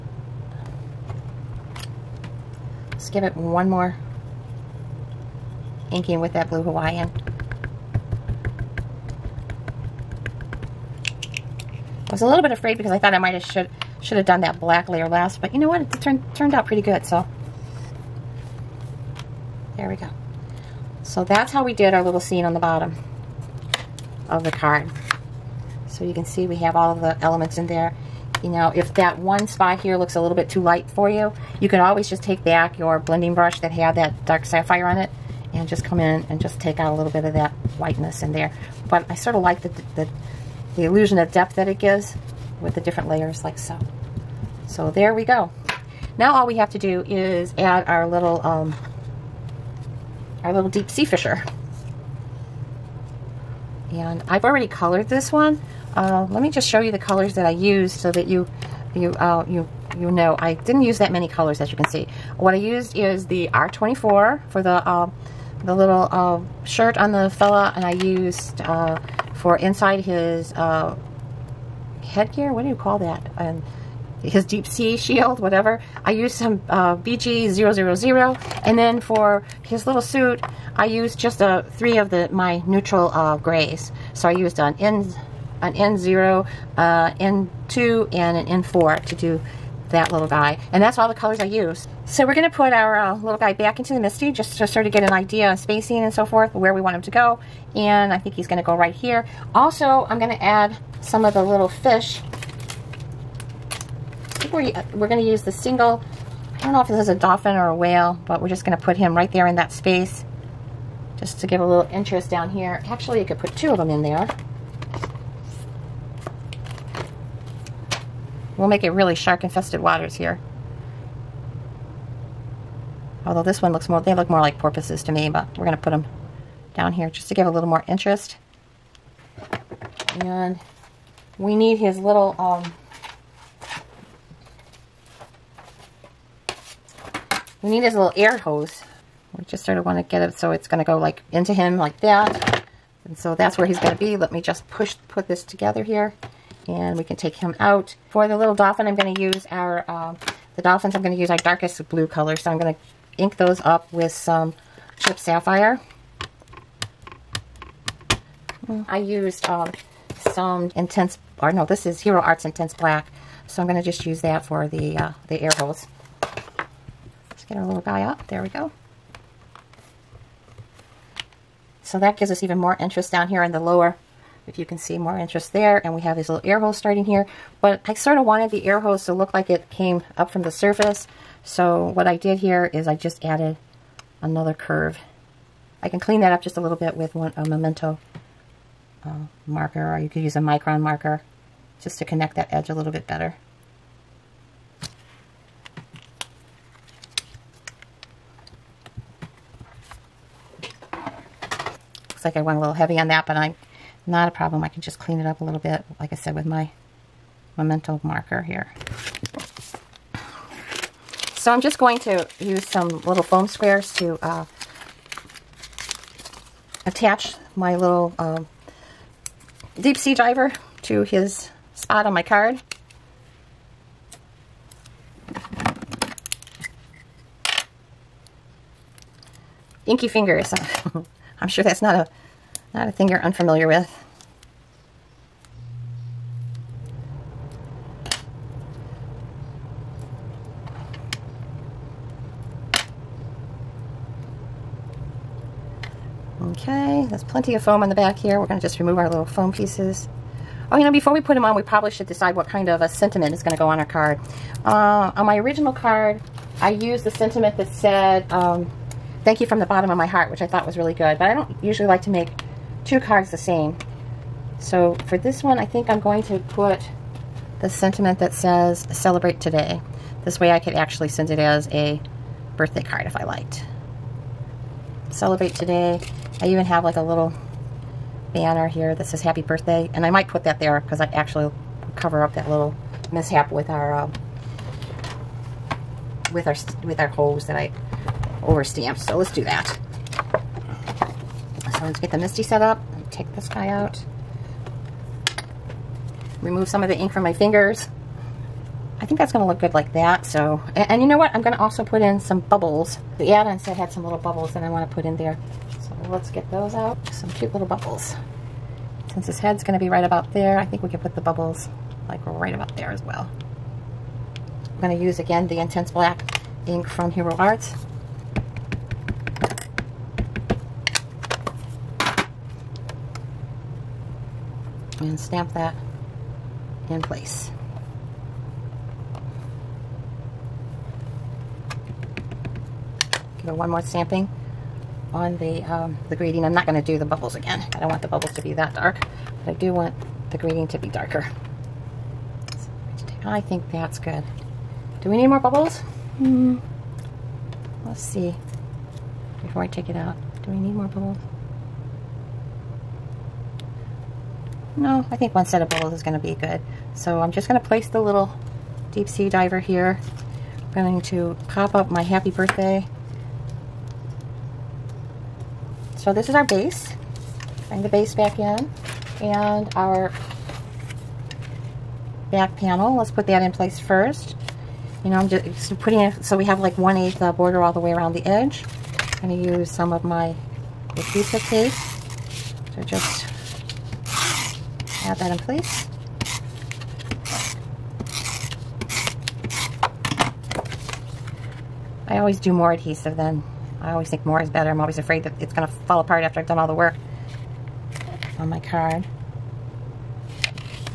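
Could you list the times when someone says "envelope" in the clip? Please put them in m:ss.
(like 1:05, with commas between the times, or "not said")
not said.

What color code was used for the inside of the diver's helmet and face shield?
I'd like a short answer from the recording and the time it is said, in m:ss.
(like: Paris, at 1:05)
BG000, at 1:16.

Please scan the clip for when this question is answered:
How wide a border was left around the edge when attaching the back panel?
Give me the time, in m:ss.
6:16.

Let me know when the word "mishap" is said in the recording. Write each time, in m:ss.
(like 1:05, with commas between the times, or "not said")
4:43.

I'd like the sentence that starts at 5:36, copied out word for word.
I'm not going to do the bubbles again.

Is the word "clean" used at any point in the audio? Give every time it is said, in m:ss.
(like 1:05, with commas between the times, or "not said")
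3:05, 3:24.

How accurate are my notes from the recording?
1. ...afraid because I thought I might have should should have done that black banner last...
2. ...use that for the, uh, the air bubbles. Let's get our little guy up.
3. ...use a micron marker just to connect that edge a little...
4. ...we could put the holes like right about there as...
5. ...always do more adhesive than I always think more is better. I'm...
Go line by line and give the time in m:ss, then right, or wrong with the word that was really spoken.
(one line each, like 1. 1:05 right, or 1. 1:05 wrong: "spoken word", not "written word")
1. 0:12 wrong: "layer", not "banner"
2. 2:44 wrong: "holes", not "bubbles"
3. 3:10 right
4. 5:10 wrong: "bubbles", not "holes"
5. 6:32 right.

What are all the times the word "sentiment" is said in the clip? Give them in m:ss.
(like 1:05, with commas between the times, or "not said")
4:12, 4:17, 4:27.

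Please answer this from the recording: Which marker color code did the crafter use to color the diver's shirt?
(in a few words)
R24.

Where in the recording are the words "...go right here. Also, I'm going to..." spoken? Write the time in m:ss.
1:38.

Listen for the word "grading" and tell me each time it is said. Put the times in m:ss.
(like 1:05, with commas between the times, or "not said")
5:36, 5:40.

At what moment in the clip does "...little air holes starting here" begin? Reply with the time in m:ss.
2:56.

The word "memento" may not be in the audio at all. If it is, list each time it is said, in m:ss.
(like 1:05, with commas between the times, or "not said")
3:07, 3:27.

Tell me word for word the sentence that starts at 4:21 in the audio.
But I don't usually like to make two cards the same.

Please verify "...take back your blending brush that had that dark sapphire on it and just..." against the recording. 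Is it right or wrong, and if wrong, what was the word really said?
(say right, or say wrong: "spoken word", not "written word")
right.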